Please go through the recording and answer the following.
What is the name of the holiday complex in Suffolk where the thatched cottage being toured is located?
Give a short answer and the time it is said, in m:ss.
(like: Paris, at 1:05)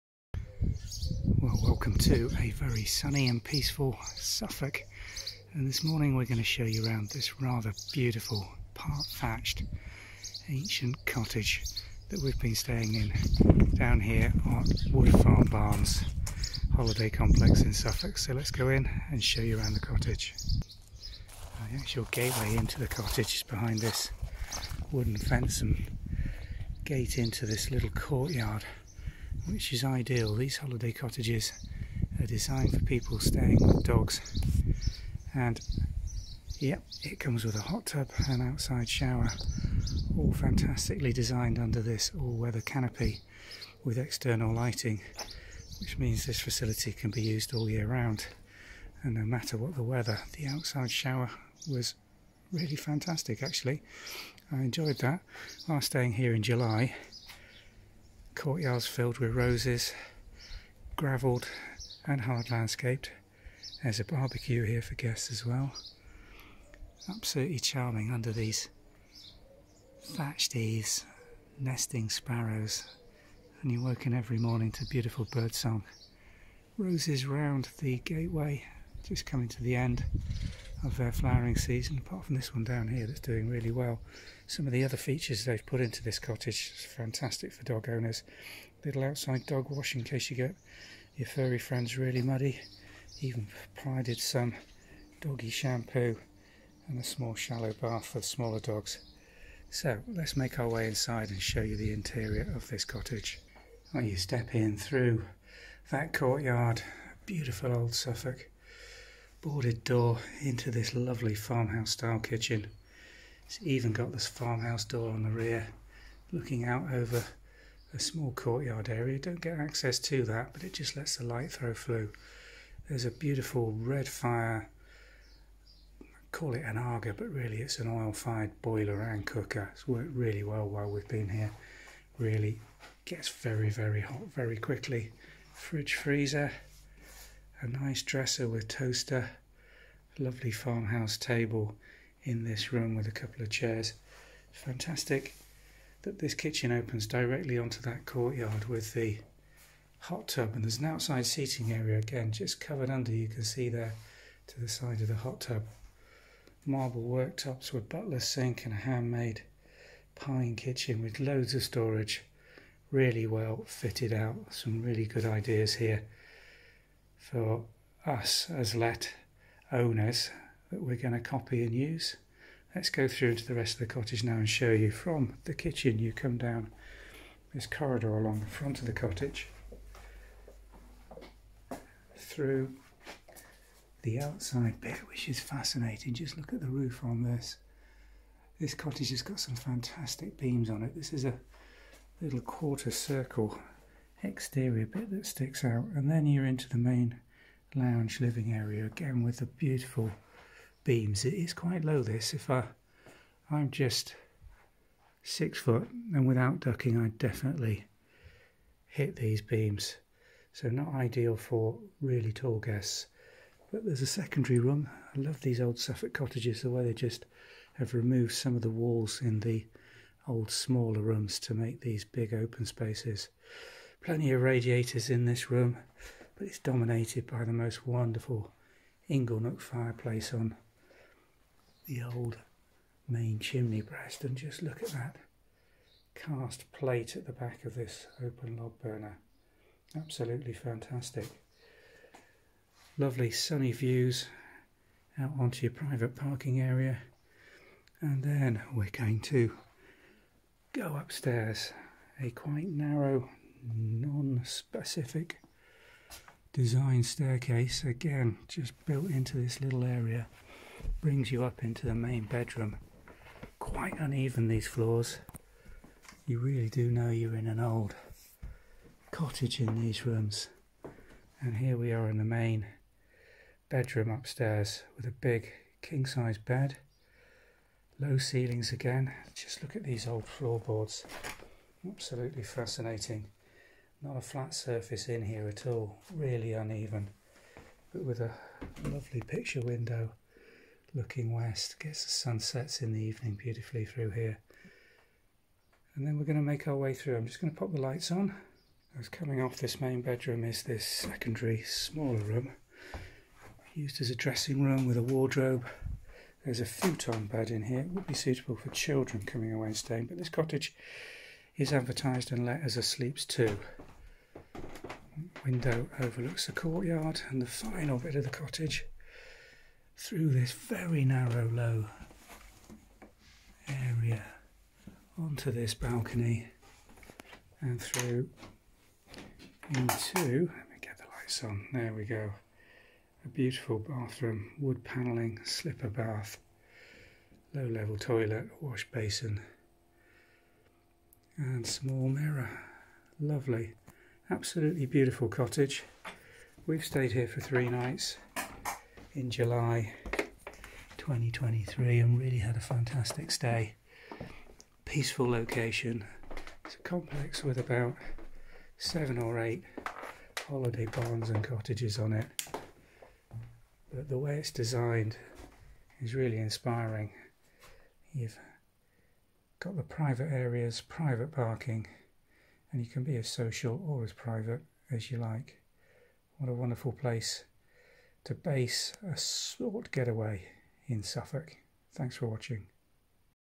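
Wood Farm Barns, at 0:14.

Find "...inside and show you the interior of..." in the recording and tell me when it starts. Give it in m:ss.
1:40.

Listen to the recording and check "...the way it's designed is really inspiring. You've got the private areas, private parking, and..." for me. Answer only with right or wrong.
right.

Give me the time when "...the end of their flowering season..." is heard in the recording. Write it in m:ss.
1:19.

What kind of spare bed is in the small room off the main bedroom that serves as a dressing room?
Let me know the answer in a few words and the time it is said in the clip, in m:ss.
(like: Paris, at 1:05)
futon, at 5:06.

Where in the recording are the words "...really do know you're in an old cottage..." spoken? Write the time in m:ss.
4:26.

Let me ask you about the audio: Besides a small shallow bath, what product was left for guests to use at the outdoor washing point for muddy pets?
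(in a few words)
doggy shampoo.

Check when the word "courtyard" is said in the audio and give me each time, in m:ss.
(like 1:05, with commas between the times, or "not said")
0:27, 0:58, 1:46, 1:58, 2:28, 5:16.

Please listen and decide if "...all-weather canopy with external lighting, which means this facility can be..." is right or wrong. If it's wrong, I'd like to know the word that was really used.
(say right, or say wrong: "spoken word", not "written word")
right.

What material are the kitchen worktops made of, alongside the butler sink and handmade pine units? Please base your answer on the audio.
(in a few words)
marble.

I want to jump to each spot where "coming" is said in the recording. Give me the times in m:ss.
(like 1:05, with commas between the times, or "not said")
1:19, 4:59, 5:09.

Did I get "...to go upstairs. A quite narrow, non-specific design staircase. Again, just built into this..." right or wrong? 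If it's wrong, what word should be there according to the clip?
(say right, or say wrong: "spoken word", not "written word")
right.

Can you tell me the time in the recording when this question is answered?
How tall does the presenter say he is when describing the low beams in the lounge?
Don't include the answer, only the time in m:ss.
3:25.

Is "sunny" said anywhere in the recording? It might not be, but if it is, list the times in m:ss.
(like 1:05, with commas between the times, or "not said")
0:02, 4:03.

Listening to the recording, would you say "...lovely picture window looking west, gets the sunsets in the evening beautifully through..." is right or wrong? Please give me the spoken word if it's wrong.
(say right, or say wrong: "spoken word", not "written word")
right.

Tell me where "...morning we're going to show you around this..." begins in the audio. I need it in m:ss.
0:05.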